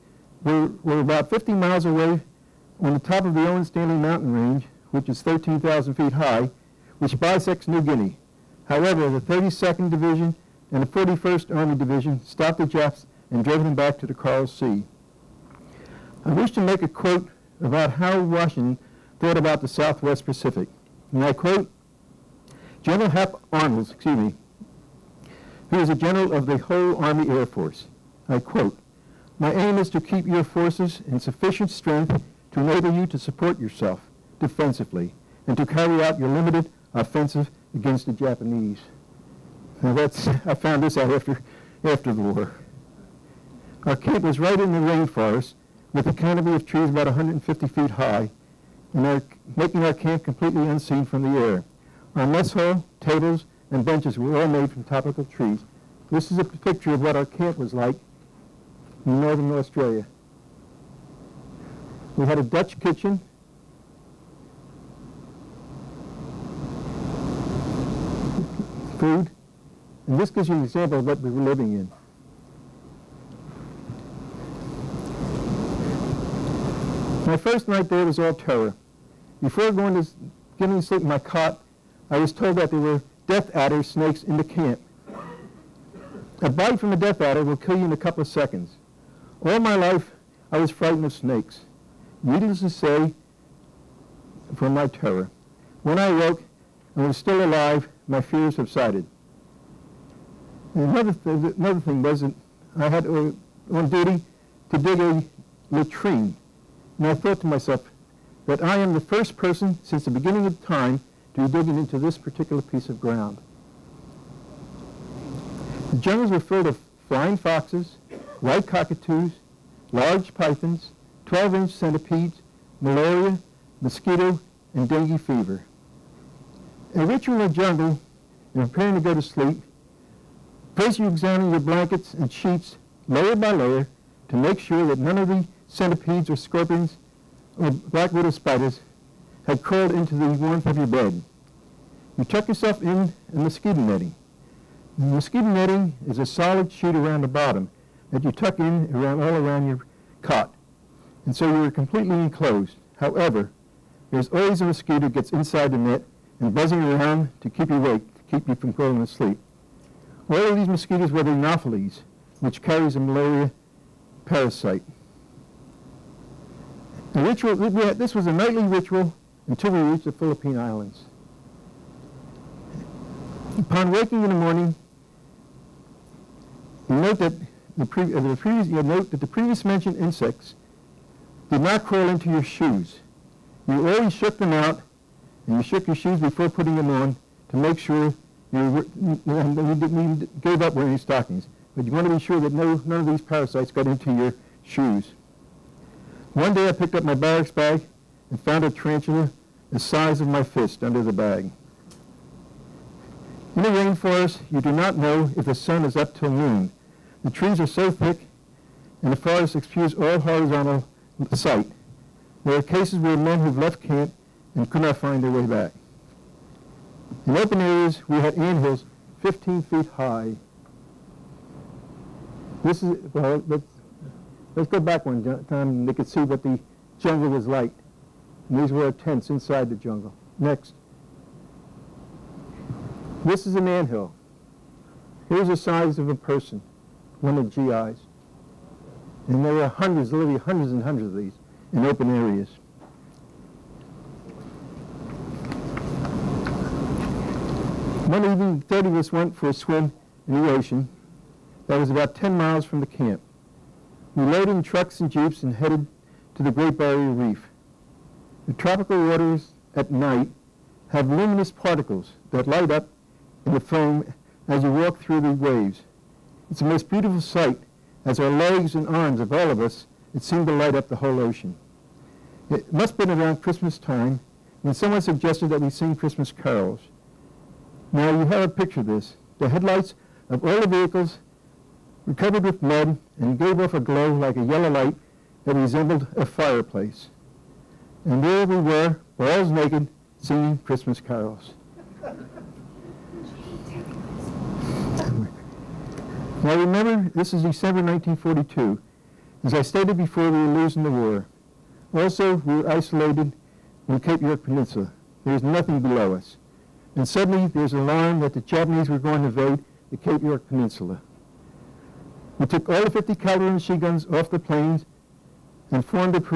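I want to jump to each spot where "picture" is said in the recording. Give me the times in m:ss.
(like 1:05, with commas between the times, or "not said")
0:56, 4:38.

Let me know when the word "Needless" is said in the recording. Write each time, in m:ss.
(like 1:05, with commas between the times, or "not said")
1:32.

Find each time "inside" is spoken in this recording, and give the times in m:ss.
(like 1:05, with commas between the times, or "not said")
2:35, 3:49.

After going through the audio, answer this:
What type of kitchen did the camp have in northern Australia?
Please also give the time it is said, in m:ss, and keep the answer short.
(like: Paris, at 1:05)
Dutch kitchen, at 1:02.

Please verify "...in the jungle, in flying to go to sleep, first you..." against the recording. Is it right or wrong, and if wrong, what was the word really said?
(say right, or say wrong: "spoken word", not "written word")
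wrong: "preparing", not "flying".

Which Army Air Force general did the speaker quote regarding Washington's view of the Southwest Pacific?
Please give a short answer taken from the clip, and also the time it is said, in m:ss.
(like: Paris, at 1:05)
Hap Arnold, at 0:23.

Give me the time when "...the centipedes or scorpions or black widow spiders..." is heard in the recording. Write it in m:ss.
2:15.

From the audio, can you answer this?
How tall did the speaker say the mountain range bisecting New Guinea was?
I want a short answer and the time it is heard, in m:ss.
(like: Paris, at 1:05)
13,000 feet, at 0:05.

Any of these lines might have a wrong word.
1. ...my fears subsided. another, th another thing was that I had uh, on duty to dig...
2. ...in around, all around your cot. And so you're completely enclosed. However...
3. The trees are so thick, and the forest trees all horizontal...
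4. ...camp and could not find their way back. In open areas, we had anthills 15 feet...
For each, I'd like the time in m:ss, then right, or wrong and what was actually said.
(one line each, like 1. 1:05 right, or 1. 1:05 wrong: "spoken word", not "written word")
1. 1:38 right
2. 2:28 right
3. 3:27 wrong: "excuses", not "trees"
4. 3:33 right.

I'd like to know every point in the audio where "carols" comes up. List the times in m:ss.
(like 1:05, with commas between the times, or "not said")
4:36, 4:51.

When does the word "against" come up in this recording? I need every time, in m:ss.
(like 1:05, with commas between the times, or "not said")
0:37.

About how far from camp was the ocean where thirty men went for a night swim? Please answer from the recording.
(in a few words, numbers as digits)
10 miles.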